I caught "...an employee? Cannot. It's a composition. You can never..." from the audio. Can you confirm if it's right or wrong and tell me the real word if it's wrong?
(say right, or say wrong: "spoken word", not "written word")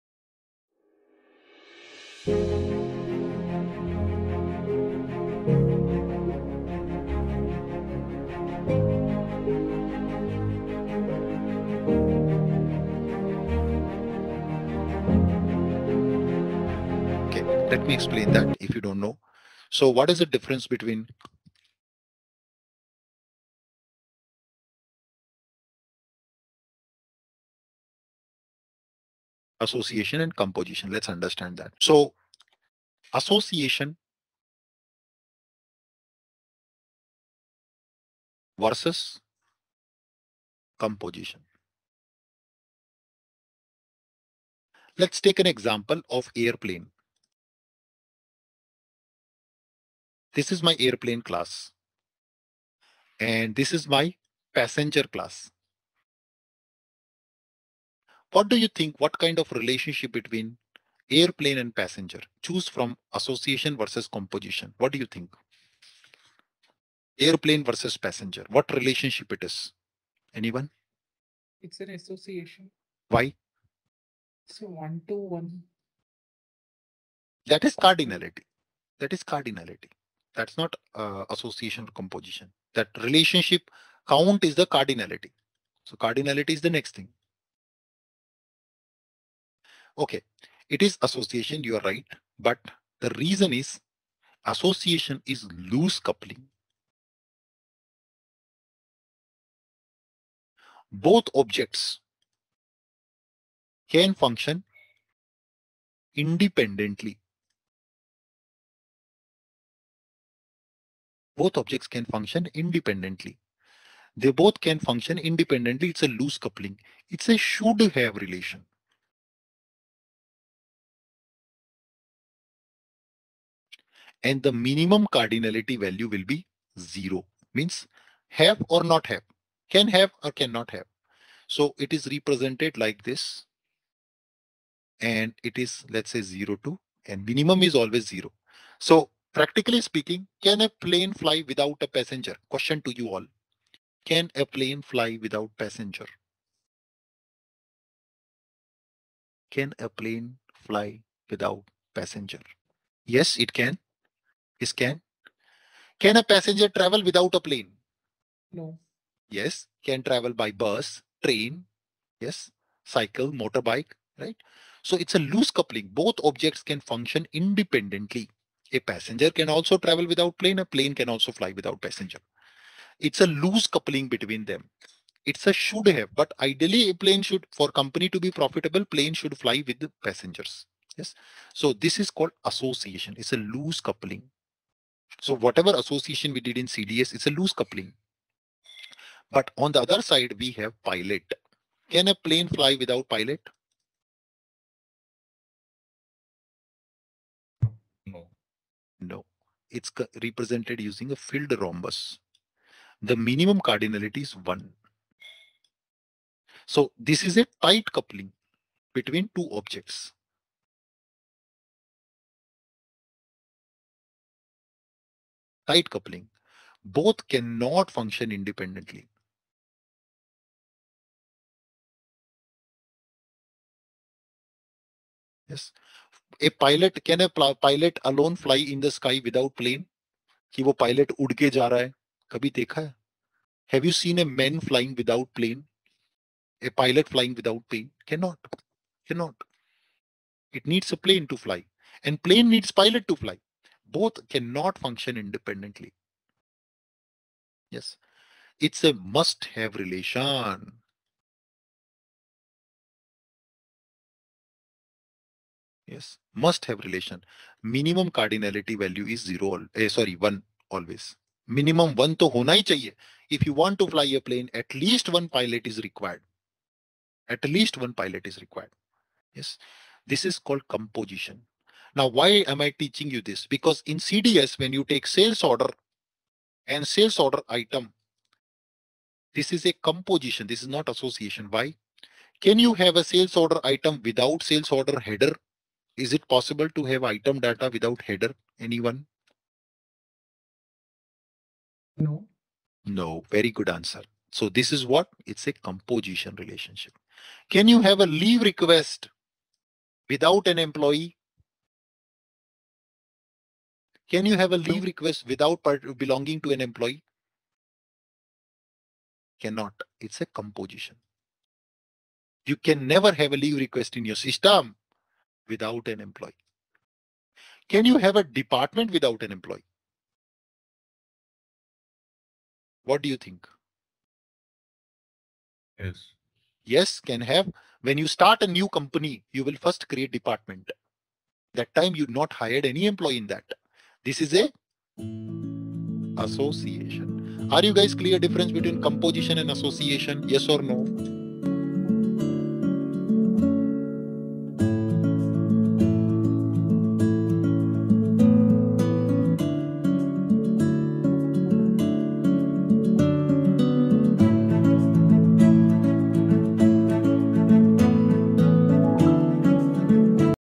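right.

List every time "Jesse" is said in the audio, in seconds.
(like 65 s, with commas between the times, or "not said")
not said.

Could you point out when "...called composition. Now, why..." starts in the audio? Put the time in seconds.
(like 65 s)
270 s.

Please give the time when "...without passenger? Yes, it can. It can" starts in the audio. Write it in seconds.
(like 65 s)
151 s.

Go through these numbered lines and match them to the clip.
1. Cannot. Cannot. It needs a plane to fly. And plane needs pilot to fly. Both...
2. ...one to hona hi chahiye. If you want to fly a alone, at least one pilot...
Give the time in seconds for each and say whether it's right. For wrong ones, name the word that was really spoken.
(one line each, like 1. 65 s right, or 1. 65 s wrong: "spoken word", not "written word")
1. 238 s right
2. 261 s wrong: "plane", not "alone".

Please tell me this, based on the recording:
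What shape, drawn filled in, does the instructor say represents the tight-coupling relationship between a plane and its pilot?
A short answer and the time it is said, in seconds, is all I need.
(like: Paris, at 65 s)
Rhombus, at 201 s.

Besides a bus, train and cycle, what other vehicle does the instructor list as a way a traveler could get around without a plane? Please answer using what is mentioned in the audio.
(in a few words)
Motorbike.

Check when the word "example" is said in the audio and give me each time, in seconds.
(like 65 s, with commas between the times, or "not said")
45 s.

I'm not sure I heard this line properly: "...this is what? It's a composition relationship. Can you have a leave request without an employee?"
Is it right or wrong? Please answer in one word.
right.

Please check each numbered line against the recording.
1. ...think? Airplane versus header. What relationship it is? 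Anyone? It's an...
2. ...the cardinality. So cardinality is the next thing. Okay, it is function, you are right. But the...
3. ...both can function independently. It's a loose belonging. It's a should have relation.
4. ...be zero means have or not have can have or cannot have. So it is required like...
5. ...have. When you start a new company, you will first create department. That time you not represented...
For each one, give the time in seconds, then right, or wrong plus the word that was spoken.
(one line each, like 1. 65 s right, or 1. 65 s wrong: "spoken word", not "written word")
1. 65 s wrong: "passenger", not "header"
2. 84 s wrong: "association", not "function"
3. 114 s wrong: "coupling", not "belonging"
4. 126 s wrong: "represented", not "required"
5. 327 s wrong: "hired", not "represented".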